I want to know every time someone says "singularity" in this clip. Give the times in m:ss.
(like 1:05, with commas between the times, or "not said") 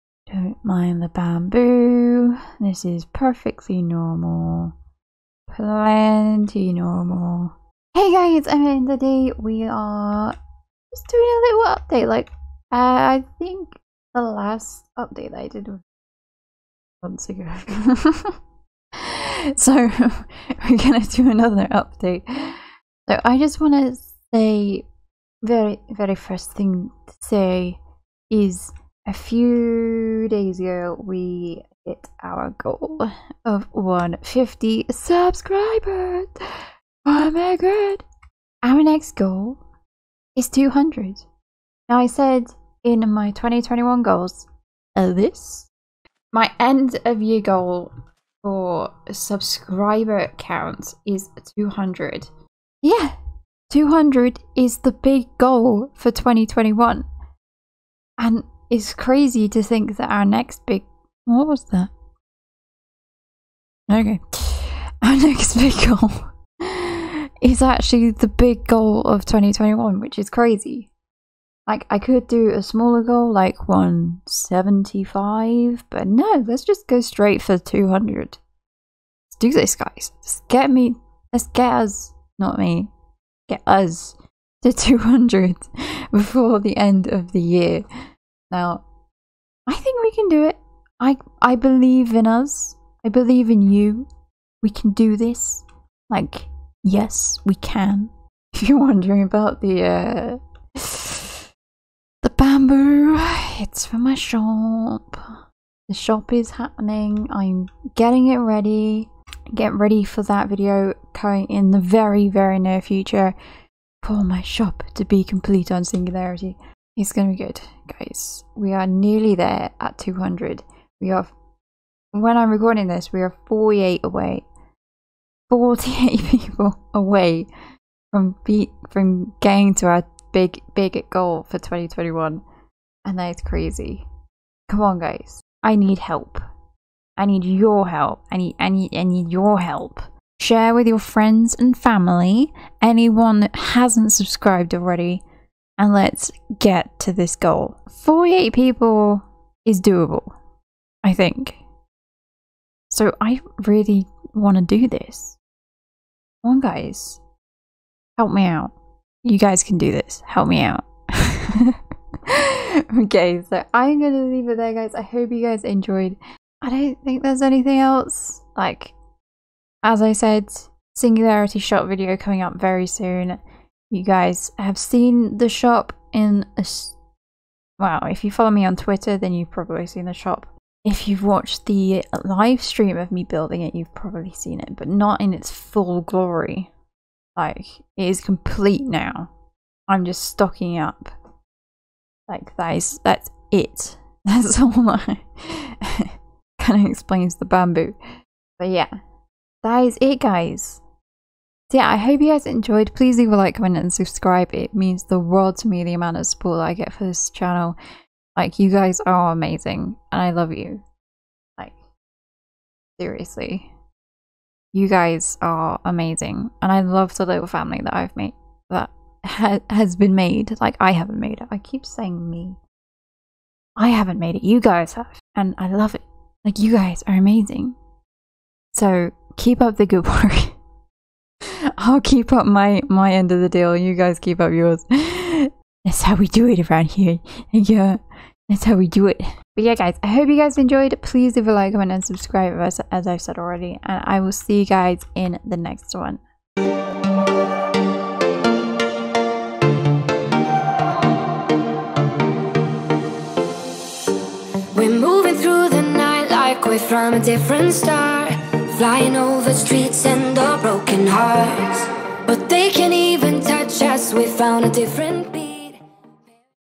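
1:55, 2:50.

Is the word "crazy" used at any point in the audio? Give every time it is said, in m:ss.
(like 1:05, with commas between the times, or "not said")
0:58, 1:10, 2:13.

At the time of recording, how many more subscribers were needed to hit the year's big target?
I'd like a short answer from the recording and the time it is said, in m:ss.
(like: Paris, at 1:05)
48, at 2:03.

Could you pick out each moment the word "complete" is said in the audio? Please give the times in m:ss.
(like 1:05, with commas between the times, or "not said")
1:55, 3:08.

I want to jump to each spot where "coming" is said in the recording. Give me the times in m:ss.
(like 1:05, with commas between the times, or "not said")
1:51, 2:52.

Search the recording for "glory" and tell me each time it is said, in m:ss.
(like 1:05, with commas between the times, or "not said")
3:06.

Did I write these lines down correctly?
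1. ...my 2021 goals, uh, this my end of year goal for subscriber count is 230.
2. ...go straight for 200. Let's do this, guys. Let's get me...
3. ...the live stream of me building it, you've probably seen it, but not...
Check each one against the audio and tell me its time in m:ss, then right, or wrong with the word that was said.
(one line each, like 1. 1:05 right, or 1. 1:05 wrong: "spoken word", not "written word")
1. 0:43 wrong: "200", not "230"
2. 1:16 right
3. 3:01 right.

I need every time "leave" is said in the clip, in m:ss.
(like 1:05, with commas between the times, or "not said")
2:44, 3:23, 4:01.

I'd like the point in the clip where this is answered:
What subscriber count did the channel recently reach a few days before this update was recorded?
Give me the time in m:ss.
0:33.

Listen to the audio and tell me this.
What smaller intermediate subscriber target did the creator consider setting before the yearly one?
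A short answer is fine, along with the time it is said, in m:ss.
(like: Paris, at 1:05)
175, at 1:13.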